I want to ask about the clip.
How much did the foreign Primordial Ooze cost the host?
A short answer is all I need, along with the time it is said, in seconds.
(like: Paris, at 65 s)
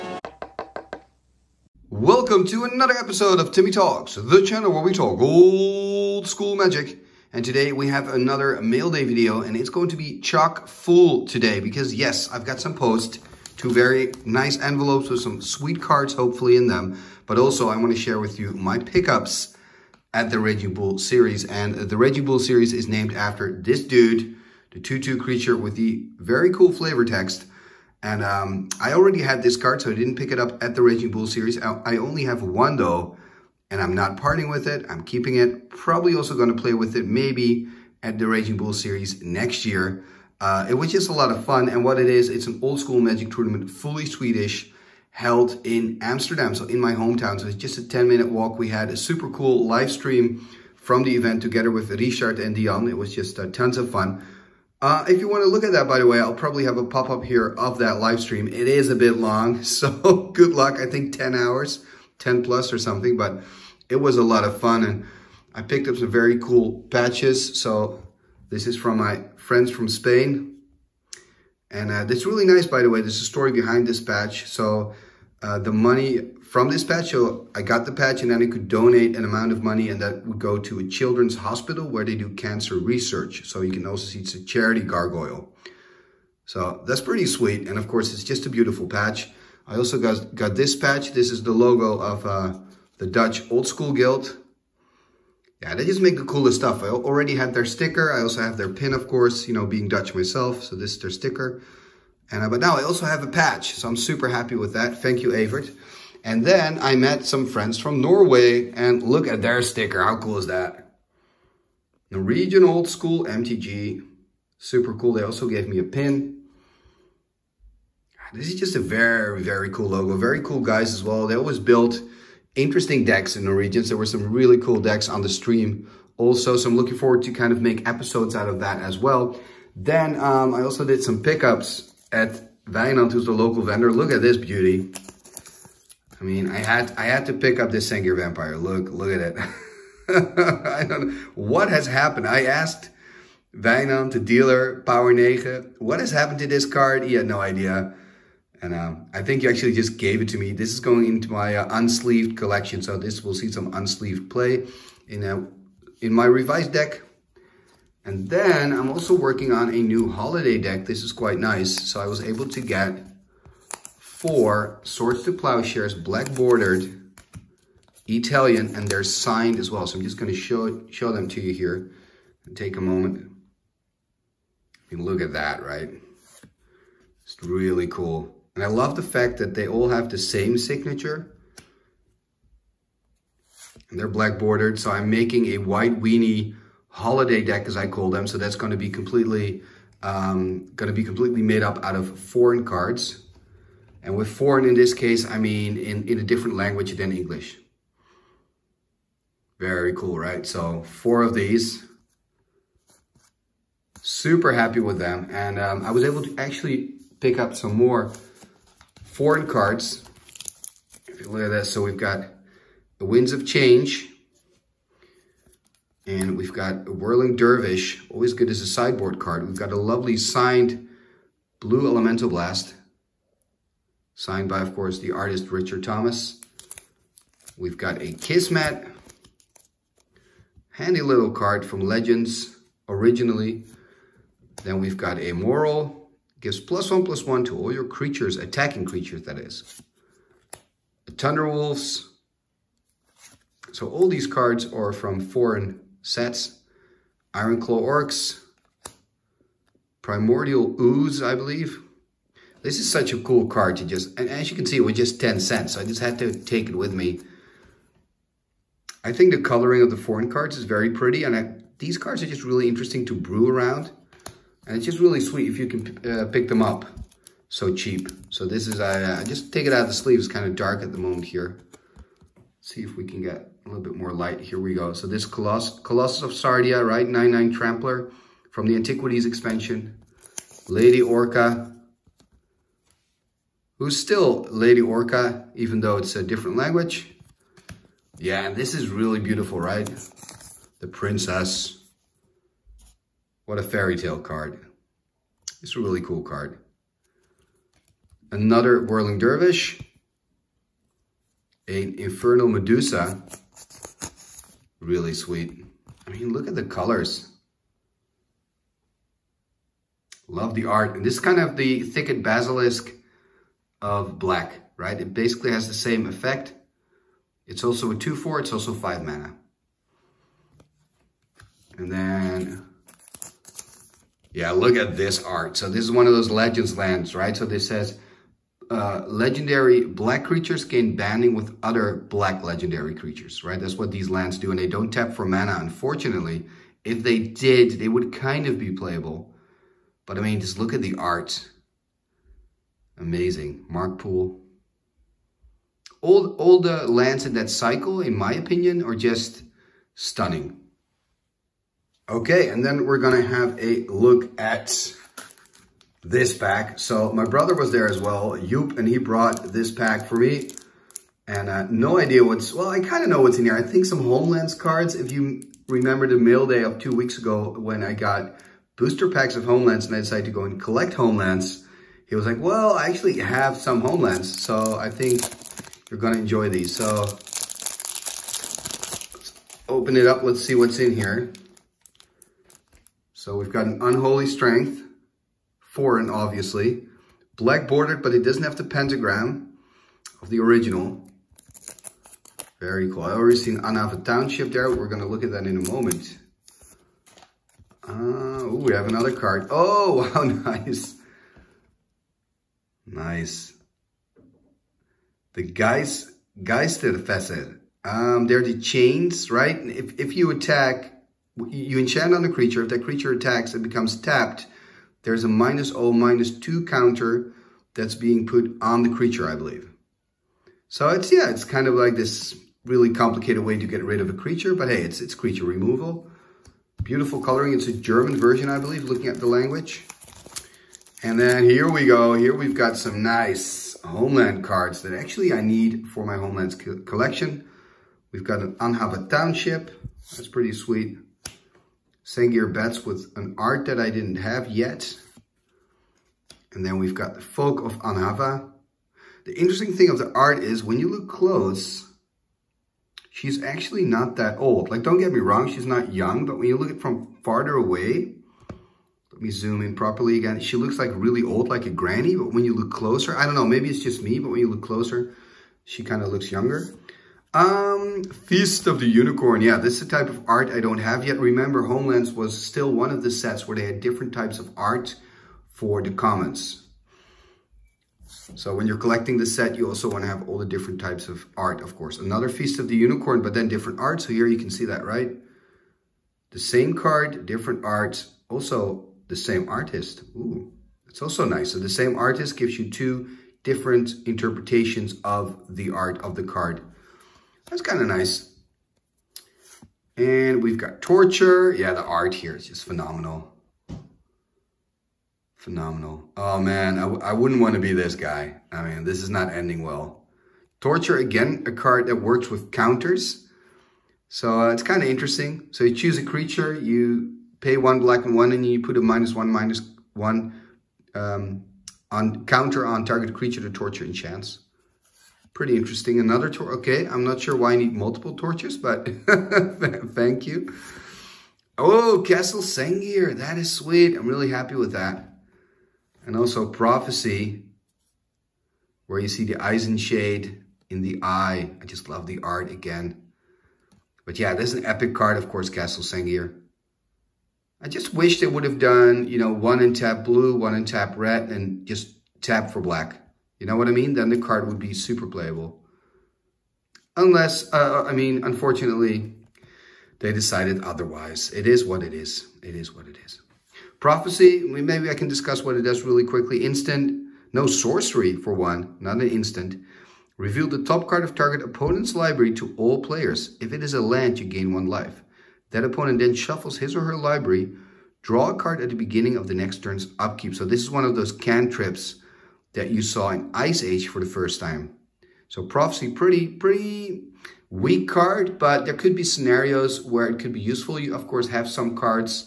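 10 cents, at 255 s.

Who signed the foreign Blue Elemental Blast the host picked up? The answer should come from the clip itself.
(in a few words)
Richard Thomas.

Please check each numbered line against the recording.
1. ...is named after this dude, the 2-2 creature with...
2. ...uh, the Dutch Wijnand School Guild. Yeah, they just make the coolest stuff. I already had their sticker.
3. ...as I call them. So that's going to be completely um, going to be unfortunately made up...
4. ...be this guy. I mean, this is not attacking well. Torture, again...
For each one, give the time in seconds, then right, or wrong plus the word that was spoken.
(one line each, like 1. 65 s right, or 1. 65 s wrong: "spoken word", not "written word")
1. 22 s right
2. 92 s wrong: "Old", not "Wijnand"
3. 187 s wrong: "completely", not "unfortunately"
4. 507 s wrong: "ending", not "attacking".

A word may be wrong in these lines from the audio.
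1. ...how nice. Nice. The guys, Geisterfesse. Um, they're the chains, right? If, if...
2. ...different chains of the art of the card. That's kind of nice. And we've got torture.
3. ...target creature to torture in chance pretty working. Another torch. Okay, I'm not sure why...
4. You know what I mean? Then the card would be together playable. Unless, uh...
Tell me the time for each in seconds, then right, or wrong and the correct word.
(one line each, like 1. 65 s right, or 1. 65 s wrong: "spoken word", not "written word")
1. 400 s right
2. 493 s wrong: "interpretations", not "chains"
3. 522 s wrong: "interesting", not "working"
4. 553 s wrong: "super", not "together".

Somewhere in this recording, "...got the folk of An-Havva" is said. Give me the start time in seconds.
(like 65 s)
446 s.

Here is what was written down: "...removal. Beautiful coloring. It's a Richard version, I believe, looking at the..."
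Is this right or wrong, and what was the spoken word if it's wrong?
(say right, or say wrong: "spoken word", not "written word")
wrong: "German", not "Richard".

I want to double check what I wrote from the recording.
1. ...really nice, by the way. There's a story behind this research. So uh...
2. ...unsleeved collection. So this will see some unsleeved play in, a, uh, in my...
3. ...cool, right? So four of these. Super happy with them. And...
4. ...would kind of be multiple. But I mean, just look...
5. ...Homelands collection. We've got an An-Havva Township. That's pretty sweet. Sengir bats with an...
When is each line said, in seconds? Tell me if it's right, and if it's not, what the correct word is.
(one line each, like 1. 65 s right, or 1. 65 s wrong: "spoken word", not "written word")
1. 72 s wrong: "patch", not "research"
2. 151 s right
3. 199 s right
4. 337 s wrong: "playable", not "multiple"
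5. 436 s right.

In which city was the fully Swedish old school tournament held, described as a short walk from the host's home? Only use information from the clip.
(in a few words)
Amsterdam.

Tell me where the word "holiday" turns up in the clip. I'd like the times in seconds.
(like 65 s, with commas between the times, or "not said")
160 s, 186 s.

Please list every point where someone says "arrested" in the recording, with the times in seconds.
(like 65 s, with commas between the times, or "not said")
not said.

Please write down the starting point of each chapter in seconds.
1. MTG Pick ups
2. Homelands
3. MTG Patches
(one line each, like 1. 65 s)
1. 129 s
2. 356 s
3. 66 s.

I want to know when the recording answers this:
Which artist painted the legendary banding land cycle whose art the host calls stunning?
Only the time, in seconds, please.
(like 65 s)
343 s.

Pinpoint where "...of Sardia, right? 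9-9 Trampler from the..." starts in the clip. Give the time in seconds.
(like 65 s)
276 s.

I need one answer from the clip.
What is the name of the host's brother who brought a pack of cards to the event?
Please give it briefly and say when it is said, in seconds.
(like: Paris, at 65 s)
Yoop, at 358 s.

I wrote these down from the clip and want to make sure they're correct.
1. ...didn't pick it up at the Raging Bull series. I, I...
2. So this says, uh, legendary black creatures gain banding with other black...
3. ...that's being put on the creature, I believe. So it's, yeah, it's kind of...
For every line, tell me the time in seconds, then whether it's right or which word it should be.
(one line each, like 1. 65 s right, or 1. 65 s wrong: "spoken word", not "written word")
1. 29 s right
2. 327 s right
3. 417 s right.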